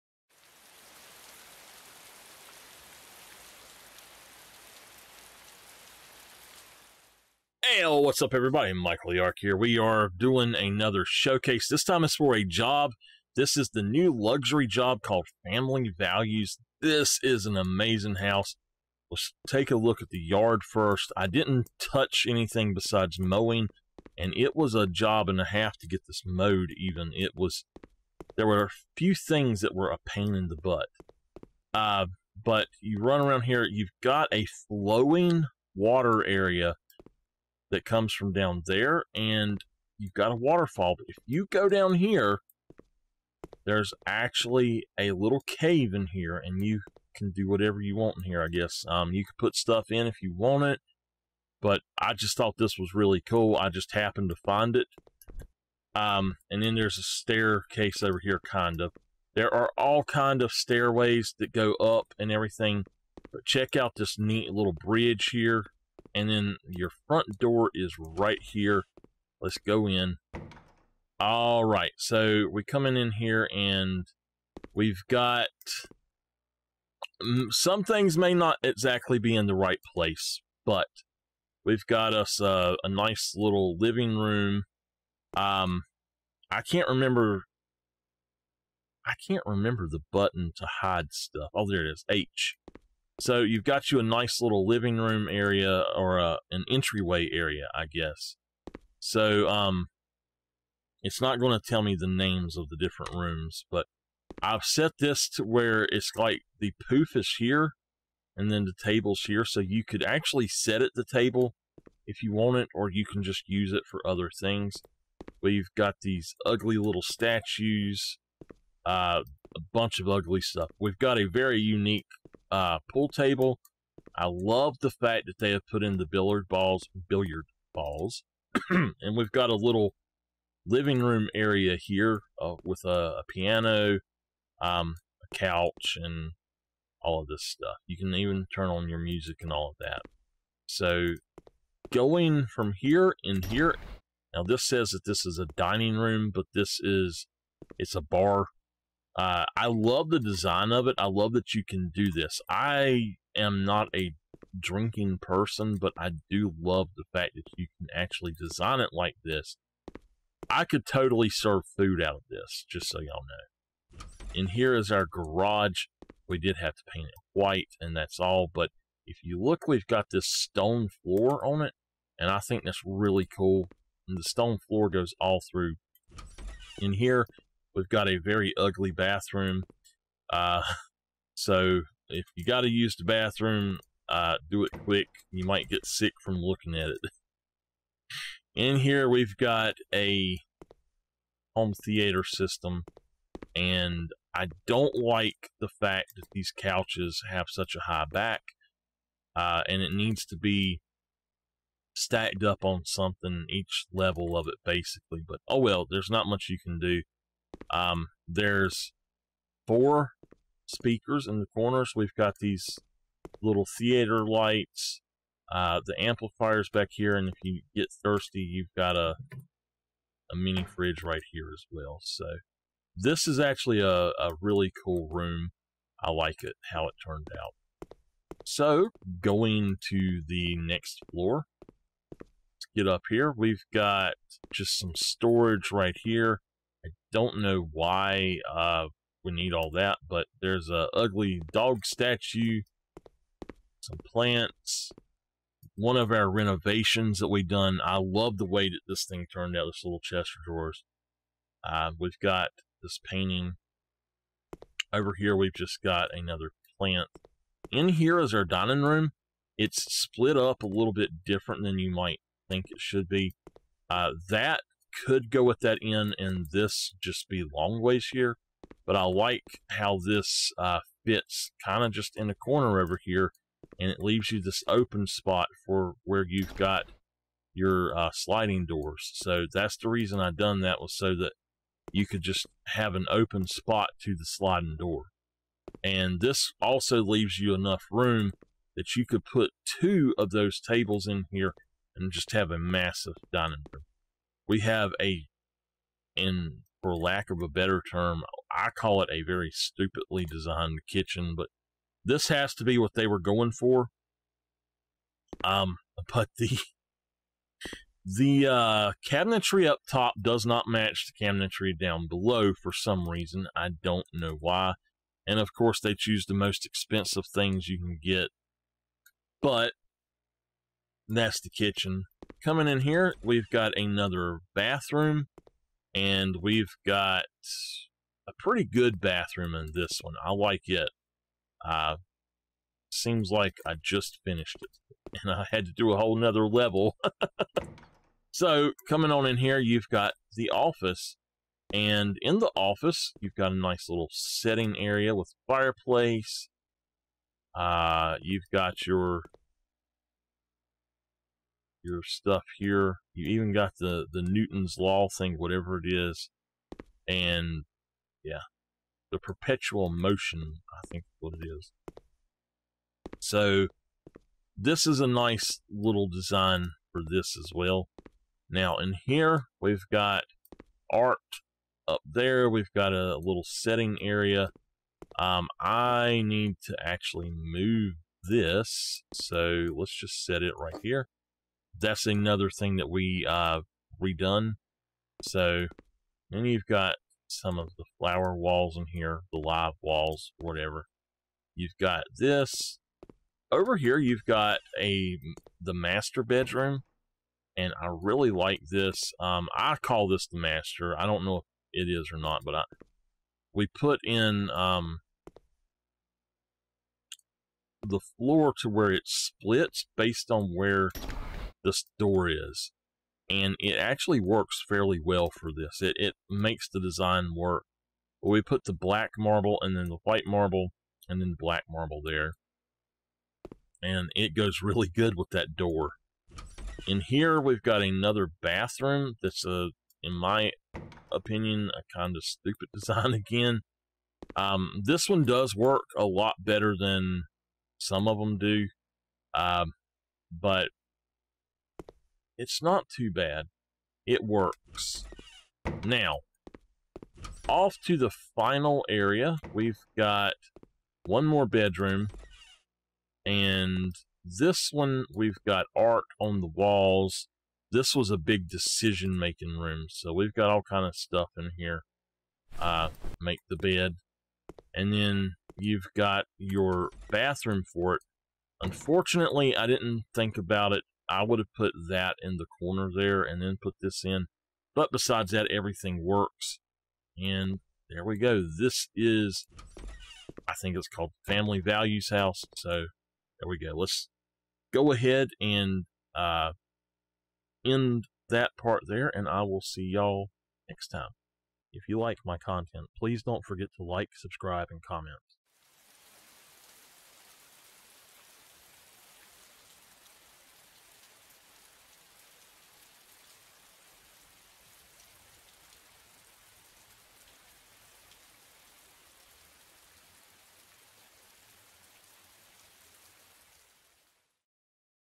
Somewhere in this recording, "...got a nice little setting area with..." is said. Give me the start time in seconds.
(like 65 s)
343 s.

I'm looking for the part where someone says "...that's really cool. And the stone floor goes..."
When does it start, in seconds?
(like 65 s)
172 s.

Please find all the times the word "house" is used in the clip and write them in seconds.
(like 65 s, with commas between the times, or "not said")
18 s, 482 s.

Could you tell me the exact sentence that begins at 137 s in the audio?
You can even turn on your music and all of that.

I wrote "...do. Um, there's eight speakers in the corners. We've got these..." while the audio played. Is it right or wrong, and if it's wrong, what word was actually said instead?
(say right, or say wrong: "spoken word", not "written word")
wrong: "four", not "eight".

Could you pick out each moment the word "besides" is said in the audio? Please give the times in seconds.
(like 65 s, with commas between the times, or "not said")
22 s, 474 s.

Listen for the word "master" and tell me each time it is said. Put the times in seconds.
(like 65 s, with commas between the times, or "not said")
395 s, 400 s.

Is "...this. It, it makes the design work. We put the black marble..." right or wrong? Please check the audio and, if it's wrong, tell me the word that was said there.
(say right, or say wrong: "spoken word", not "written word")
right.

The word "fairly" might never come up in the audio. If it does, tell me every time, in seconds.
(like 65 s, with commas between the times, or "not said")
414 s.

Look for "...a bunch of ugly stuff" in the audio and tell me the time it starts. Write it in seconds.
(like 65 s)
119 s.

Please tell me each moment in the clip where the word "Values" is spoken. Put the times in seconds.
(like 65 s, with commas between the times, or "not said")
15 s, 481 s.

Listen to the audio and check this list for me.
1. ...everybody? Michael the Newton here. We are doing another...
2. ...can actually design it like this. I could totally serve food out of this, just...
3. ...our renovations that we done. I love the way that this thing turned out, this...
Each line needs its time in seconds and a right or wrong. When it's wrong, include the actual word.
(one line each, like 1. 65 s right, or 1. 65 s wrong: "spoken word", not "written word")
1. 8 s wrong: "Arch", not "Newton"
2. 157 s right
3. 246 s right.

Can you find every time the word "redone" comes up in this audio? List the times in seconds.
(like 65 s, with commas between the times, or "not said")
384 s.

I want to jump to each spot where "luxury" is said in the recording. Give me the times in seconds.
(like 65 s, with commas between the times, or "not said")
14 s.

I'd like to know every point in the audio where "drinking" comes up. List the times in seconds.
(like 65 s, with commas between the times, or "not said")
154 s.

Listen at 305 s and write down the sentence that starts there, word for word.
Um, but the the uh, cabinetry up top does not match the cabinetry down below for some reason.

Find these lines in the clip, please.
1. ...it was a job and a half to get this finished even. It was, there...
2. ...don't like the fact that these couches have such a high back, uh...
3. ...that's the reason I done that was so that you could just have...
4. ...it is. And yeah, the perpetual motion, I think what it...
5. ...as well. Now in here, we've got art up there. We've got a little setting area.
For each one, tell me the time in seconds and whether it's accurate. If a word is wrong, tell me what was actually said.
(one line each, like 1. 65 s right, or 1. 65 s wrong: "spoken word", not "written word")
1. 24 s wrong: "mowed", not "finished"
2. 194 s right
3. 279 s right
4. 355 s right
5. 367 s right.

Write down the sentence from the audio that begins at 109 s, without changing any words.
So you could actually set it the table if you want it, or you can just use it for other things.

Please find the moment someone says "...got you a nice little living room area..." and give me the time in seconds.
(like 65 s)
93 s.